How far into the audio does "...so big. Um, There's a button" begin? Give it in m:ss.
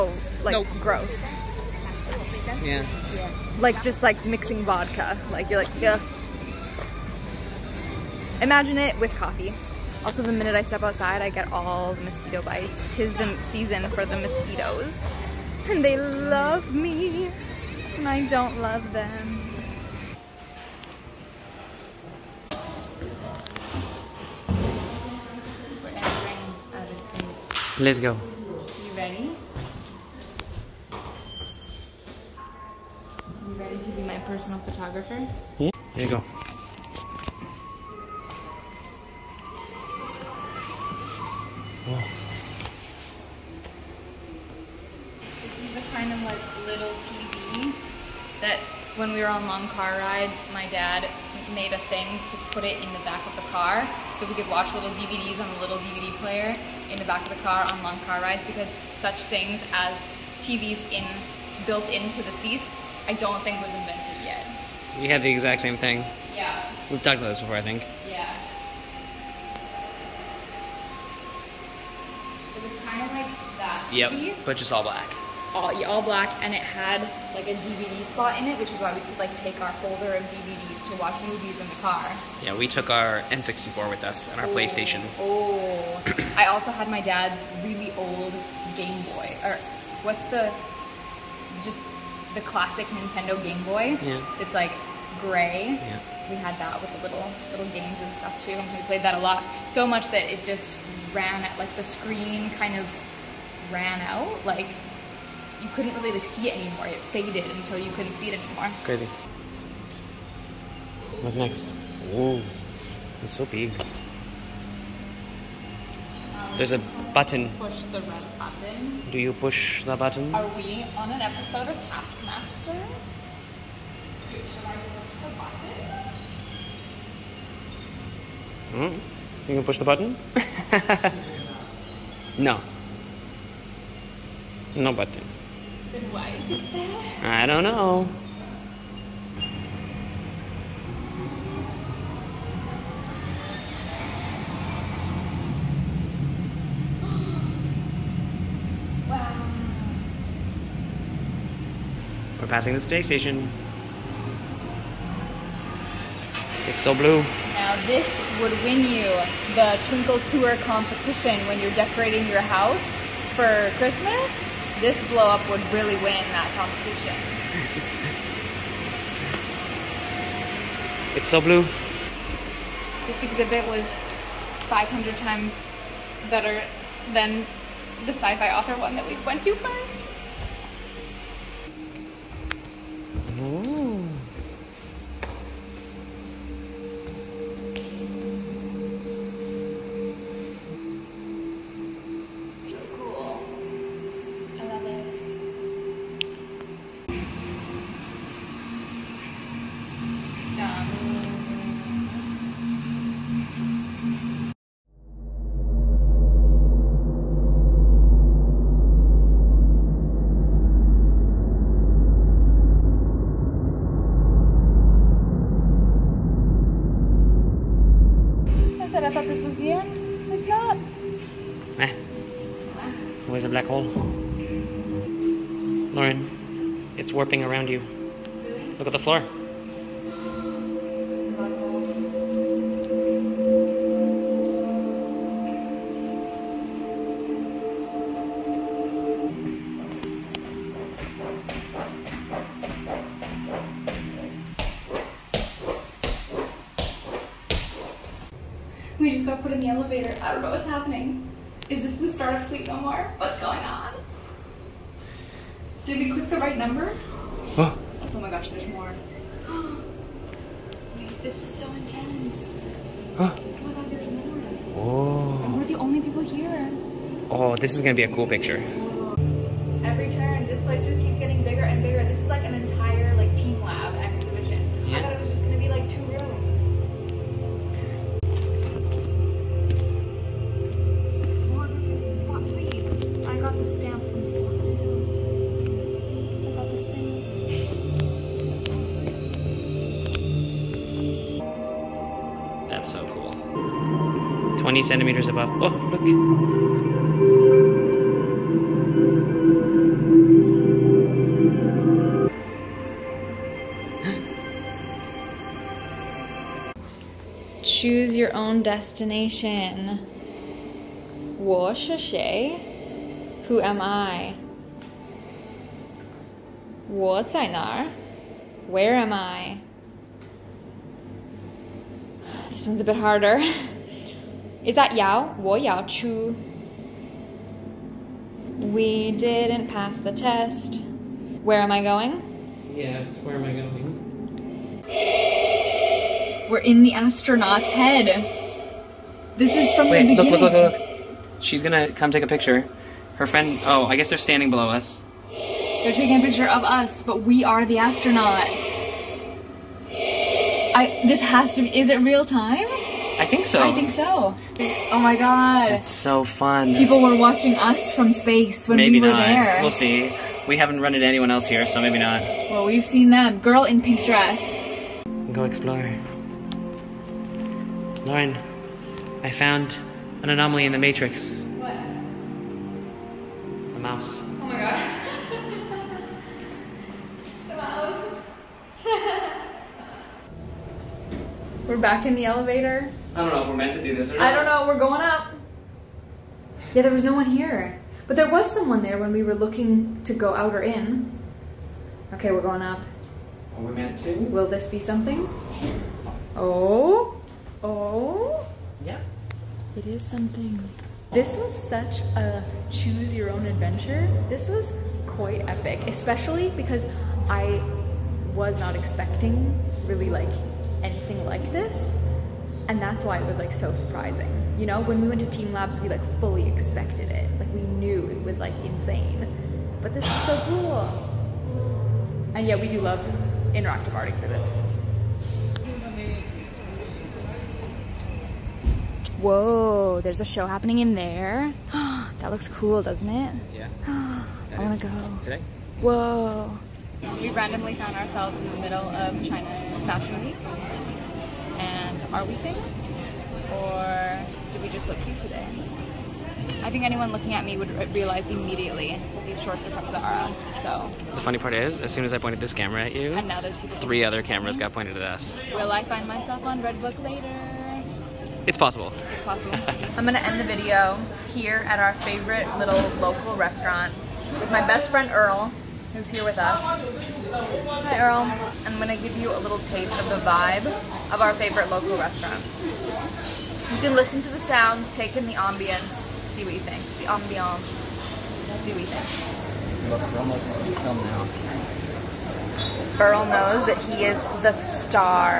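1:53.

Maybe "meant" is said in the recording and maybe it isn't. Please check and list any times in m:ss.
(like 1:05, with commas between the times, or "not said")
6:23, 6:33.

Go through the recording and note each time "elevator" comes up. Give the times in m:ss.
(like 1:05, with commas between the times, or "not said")
4:09, 6:22.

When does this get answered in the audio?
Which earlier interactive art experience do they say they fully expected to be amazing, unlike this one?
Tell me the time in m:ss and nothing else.
6:55.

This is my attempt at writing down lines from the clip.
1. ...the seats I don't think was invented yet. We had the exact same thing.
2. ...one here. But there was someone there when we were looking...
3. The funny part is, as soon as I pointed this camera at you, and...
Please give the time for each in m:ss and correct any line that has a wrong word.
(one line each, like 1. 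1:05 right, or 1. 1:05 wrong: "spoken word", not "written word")
1. 1:02 right
2. 6:27 right
3. 7:31 right.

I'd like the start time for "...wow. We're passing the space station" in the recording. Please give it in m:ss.
2:29.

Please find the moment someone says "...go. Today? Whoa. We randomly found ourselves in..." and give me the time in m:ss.
7:14.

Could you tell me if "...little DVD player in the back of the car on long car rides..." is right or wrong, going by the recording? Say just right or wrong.
right.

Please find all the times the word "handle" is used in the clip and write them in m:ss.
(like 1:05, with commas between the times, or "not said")
not said.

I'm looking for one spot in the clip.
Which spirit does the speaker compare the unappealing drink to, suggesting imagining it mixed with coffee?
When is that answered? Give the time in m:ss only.
0:04.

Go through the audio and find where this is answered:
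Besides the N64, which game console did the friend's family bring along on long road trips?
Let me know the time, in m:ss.
1:24.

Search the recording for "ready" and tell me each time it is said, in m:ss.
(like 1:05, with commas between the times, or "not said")
0:28, 0:33.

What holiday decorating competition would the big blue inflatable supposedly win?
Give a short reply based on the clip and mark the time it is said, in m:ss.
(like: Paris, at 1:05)
Twinkle Tour, at 2:39.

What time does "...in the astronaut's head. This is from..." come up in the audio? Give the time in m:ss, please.
5:36.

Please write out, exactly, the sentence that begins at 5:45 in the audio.
They're taking a picture of us, but we are the astronaut.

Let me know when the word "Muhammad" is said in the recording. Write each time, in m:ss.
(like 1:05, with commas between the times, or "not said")
not said.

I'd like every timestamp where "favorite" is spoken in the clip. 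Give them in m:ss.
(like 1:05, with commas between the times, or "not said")
7:42, 7:51.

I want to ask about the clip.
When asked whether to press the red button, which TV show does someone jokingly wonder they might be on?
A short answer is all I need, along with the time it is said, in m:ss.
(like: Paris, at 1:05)
Taskmaster, at 2:01.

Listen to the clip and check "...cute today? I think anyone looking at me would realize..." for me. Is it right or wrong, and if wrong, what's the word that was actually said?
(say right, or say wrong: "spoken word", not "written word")
right.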